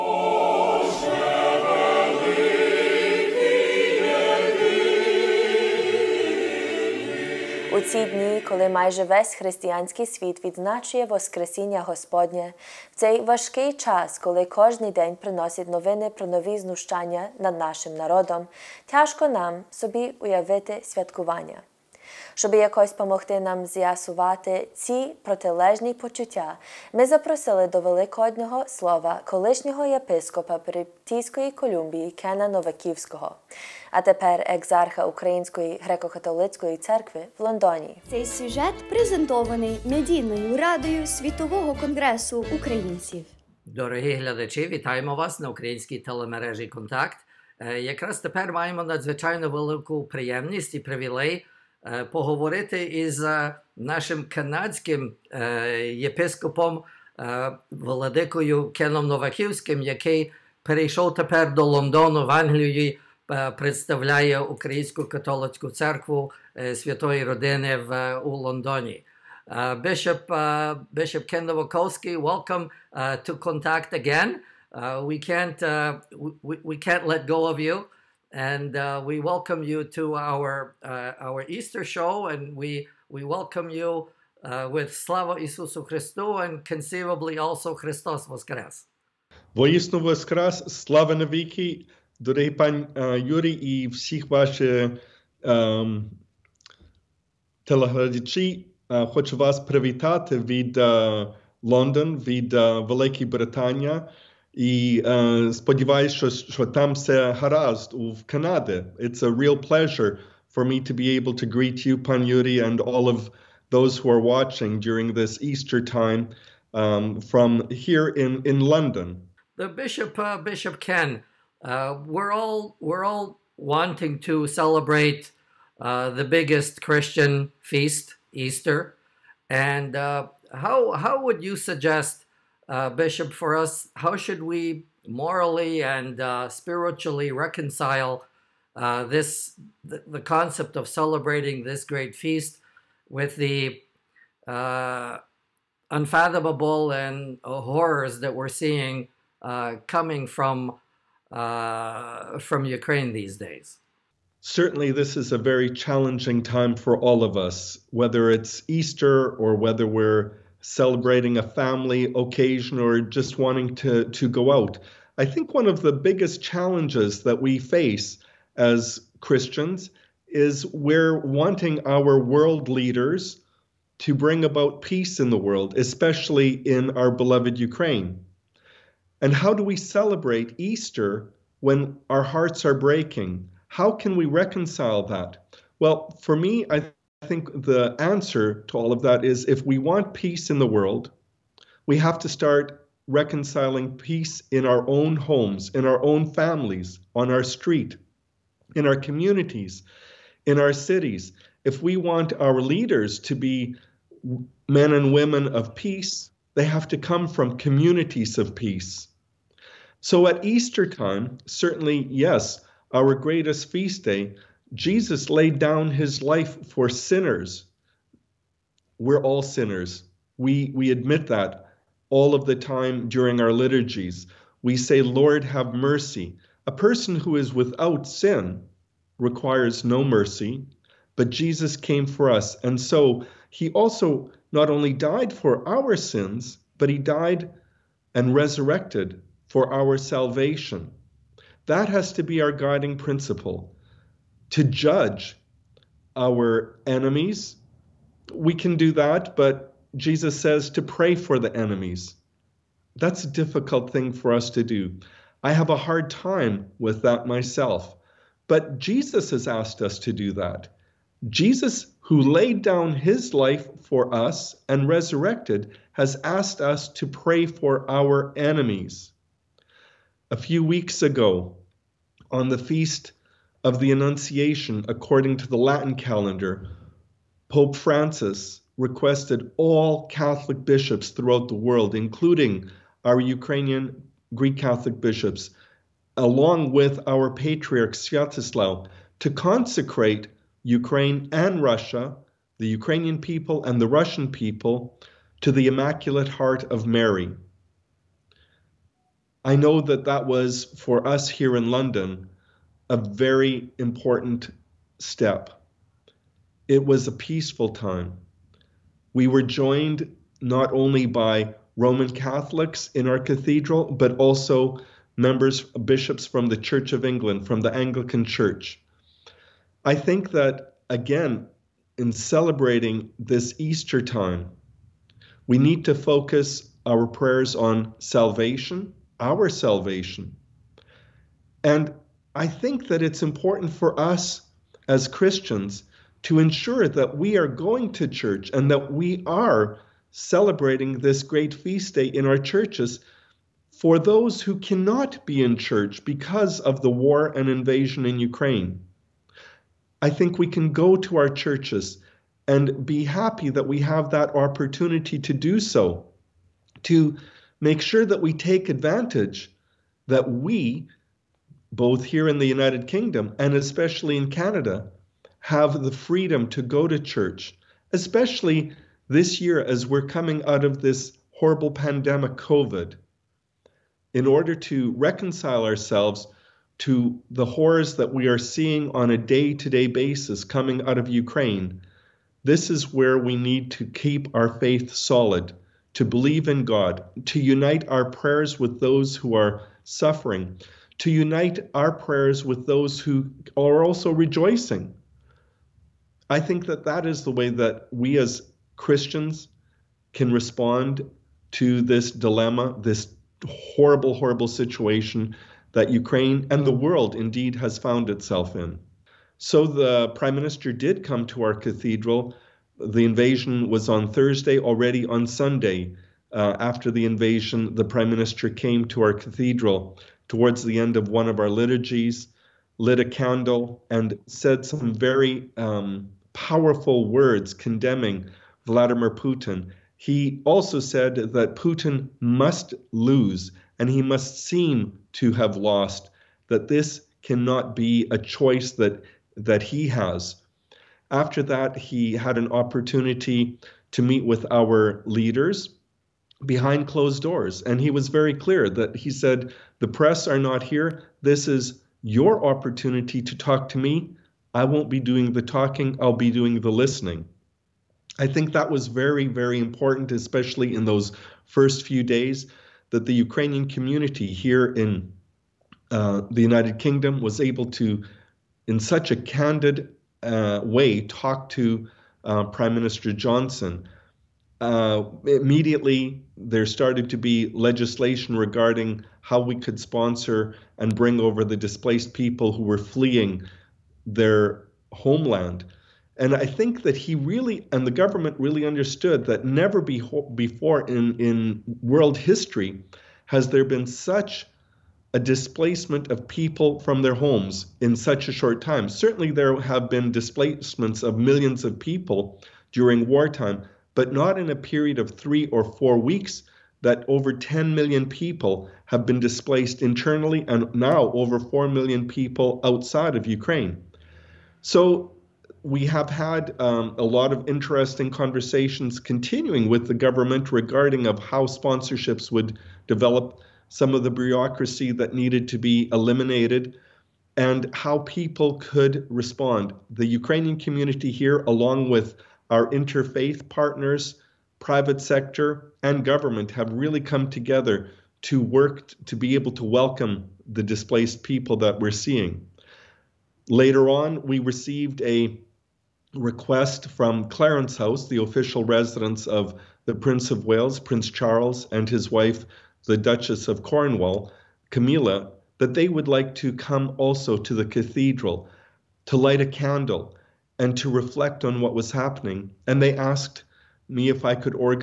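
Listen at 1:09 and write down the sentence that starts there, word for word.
Uh, Bishop uh, Bishop Ken Nowakowski, welcome uh, to Contact again.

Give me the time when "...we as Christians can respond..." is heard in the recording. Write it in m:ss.
6:37.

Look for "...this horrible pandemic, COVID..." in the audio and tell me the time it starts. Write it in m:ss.
6:10.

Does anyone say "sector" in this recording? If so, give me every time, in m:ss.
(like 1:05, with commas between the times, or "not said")
8:55.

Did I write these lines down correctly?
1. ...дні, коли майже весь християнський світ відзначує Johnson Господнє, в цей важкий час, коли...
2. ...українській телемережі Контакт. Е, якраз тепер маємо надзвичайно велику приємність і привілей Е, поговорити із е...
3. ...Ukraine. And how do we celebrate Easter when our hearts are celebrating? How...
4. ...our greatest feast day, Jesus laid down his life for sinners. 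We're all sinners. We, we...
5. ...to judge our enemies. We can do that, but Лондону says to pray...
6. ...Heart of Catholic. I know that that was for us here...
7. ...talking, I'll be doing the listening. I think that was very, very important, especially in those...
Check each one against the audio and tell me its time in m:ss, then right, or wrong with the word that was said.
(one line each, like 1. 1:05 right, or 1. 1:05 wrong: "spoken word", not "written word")
1. 0:08 wrong: "Воскресіння", not "Johnson"
2. 0:45 right
3. 2:57 wrong: "breaking", not "celebrating"
4. 3:32 right
5. 4:04 wrong: "Jesus", not "Лондону"
6. 4:56 wrong: "Mary", not "Catholic"
7. 7:35 right.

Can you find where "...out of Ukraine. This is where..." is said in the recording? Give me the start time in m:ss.
6:20.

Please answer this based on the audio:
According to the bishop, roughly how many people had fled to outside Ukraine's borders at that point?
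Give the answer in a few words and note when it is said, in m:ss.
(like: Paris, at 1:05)
over 4 million, at 8:31.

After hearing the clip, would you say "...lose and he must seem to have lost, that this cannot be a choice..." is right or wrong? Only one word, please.
right.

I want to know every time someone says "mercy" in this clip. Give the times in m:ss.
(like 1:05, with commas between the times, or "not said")
3:45, 3:50.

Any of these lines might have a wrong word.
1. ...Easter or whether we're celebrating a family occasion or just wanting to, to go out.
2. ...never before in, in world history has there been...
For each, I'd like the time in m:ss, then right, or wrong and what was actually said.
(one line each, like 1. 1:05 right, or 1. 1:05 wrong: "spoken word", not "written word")
1. 2:38 right
2. 8:09 right.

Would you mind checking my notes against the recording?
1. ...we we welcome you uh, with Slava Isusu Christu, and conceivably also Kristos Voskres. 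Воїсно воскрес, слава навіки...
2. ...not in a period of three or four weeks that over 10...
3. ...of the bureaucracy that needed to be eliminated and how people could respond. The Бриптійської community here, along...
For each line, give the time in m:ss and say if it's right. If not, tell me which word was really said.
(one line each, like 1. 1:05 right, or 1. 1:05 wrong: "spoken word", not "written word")
1. 1:22 right
2. 8:24 right
3. 8:43 wrong: "Ukrainian", not "Бриптійської".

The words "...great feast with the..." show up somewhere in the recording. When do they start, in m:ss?
2:21.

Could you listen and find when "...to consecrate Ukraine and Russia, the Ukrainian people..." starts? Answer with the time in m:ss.
4:49.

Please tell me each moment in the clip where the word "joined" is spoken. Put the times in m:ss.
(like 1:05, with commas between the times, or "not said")
5:09.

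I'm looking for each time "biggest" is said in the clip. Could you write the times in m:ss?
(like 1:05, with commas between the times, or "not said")
2:06, 2:45.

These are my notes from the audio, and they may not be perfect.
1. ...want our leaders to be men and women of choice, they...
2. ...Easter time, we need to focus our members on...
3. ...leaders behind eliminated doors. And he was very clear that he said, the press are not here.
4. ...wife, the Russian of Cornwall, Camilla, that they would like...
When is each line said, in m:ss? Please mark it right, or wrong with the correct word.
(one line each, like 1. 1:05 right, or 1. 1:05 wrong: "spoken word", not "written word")
1. 3:21 wrong: "peace", not "choice"
2. 5:23 wrong: "prayers", not "members"
3. 7:25 wrong: "closed", not "eliminated"
4. 9:12 wrong: "Duchess", not "Russian".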